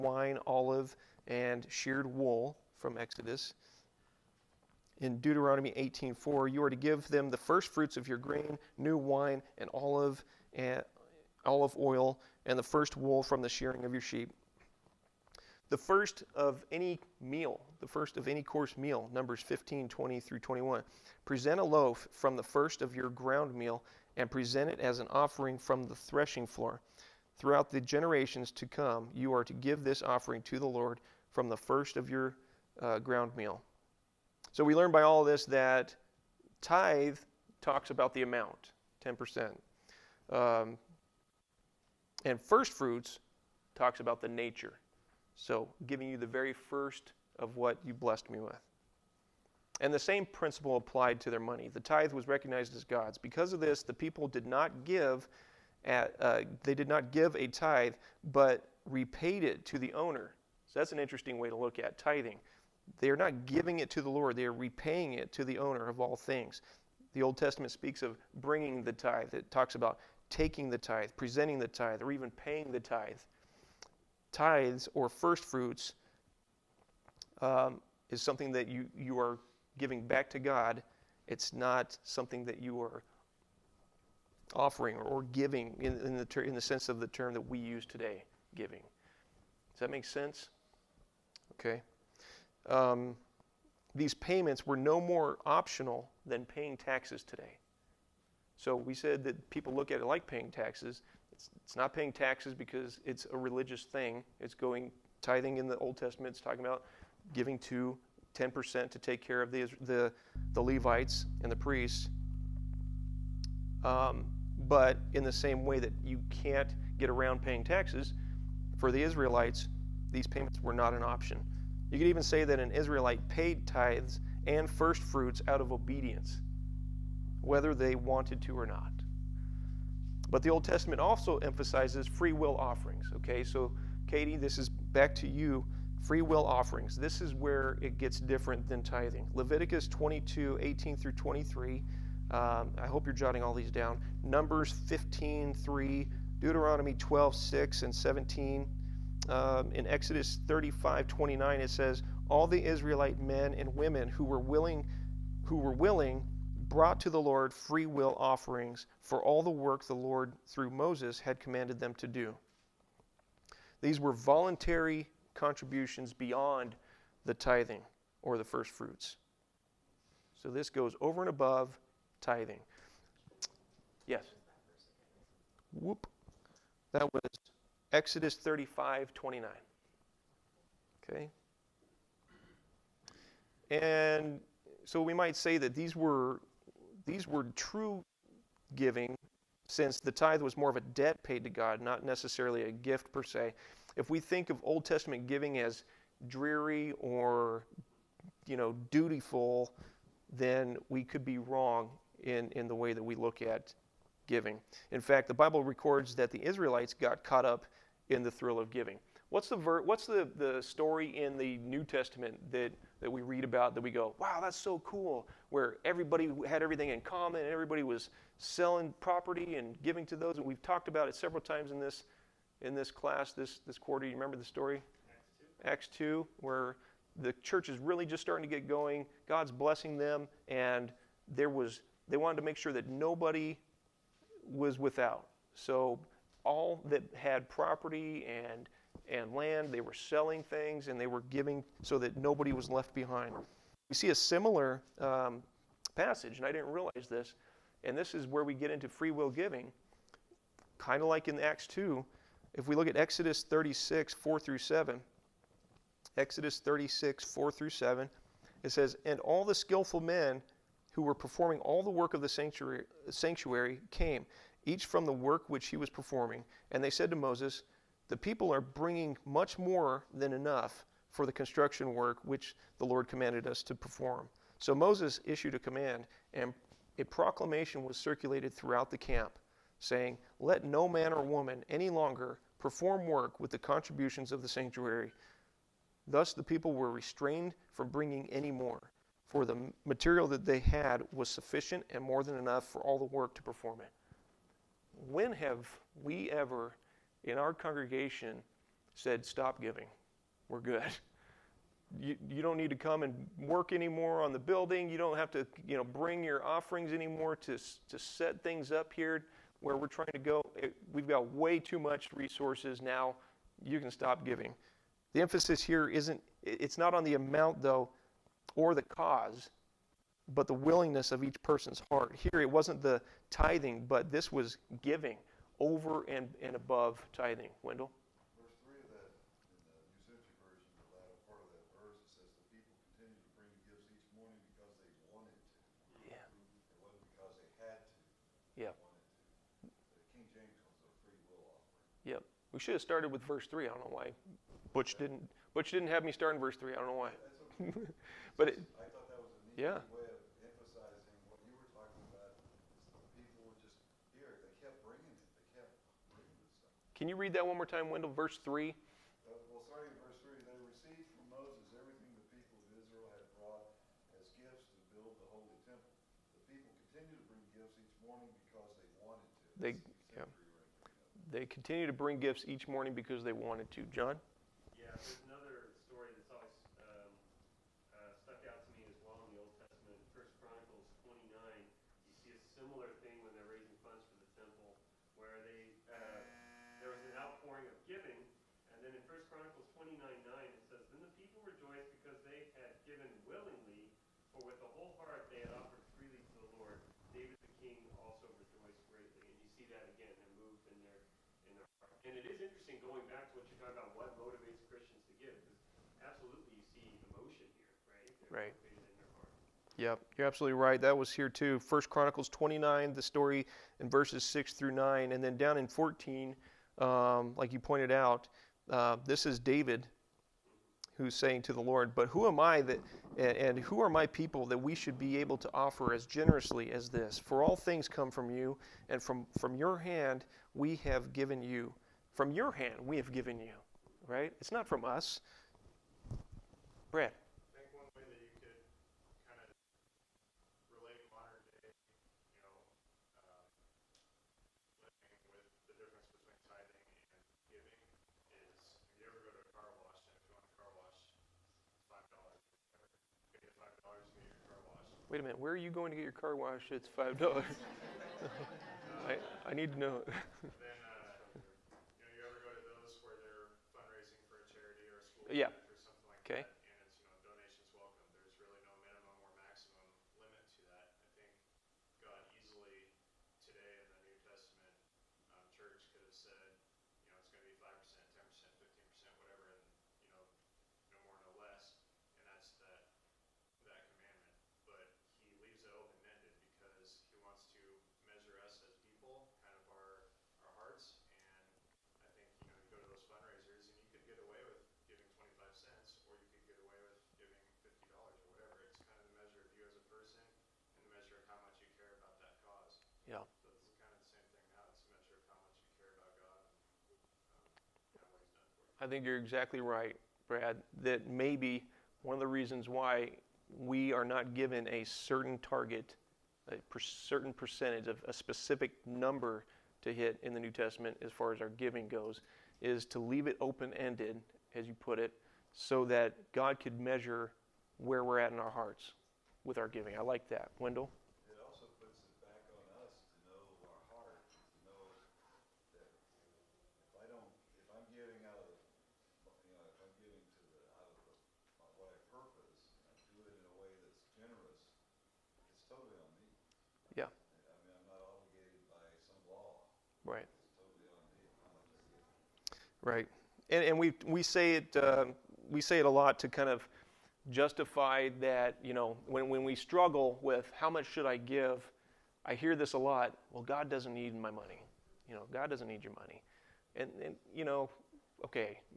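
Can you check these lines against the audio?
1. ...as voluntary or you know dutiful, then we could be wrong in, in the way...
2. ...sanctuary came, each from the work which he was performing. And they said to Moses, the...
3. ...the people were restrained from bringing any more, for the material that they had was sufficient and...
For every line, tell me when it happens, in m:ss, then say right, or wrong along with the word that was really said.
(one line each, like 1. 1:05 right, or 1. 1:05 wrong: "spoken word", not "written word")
1. 3:15 wrong: "dreary", not "voluntary"
2. 4:23 right
3. 4:46 right.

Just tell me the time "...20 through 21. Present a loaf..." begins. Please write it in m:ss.
0:19.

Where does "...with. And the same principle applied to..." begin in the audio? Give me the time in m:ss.
0:48.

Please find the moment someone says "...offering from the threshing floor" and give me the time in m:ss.
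0:25.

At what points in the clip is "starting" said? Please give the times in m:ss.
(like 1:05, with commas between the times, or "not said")
3:48.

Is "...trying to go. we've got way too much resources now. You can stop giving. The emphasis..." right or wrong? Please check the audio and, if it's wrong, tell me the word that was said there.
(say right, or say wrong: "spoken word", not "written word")
right.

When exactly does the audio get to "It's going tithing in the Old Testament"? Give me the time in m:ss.
1:44.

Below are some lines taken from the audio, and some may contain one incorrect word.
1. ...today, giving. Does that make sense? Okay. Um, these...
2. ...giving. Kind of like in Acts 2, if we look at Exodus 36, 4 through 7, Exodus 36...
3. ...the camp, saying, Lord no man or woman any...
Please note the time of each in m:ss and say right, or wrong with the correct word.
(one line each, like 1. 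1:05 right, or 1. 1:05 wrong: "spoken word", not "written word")
1. 1:27 right
2. 4:09 right
3. 4:38 wrong: "Let", not "Lord".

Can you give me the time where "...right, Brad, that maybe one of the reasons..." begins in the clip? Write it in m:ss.
8:29.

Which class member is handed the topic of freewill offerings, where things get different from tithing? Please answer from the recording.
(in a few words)
Katie.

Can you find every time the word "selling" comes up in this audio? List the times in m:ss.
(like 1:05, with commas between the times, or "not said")
3:38, 3:59.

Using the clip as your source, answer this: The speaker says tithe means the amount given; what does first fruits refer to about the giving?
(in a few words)
The nature.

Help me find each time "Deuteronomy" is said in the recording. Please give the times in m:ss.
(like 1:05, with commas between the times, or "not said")
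0:05, 2:26.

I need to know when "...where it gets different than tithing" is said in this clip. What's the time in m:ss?
2:17.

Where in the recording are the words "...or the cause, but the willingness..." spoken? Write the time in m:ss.
5:18.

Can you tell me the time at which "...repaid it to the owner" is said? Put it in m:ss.
0:58.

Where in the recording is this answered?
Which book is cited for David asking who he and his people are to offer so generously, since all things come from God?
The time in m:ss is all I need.
6:51.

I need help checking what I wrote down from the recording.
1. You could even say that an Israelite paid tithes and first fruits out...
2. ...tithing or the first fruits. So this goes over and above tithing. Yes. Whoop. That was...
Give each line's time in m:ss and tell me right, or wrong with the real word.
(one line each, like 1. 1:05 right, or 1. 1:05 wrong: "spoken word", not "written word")
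1. 2:01 right
2. 2:47 right.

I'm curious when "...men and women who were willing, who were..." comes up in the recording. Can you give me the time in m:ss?
2:33.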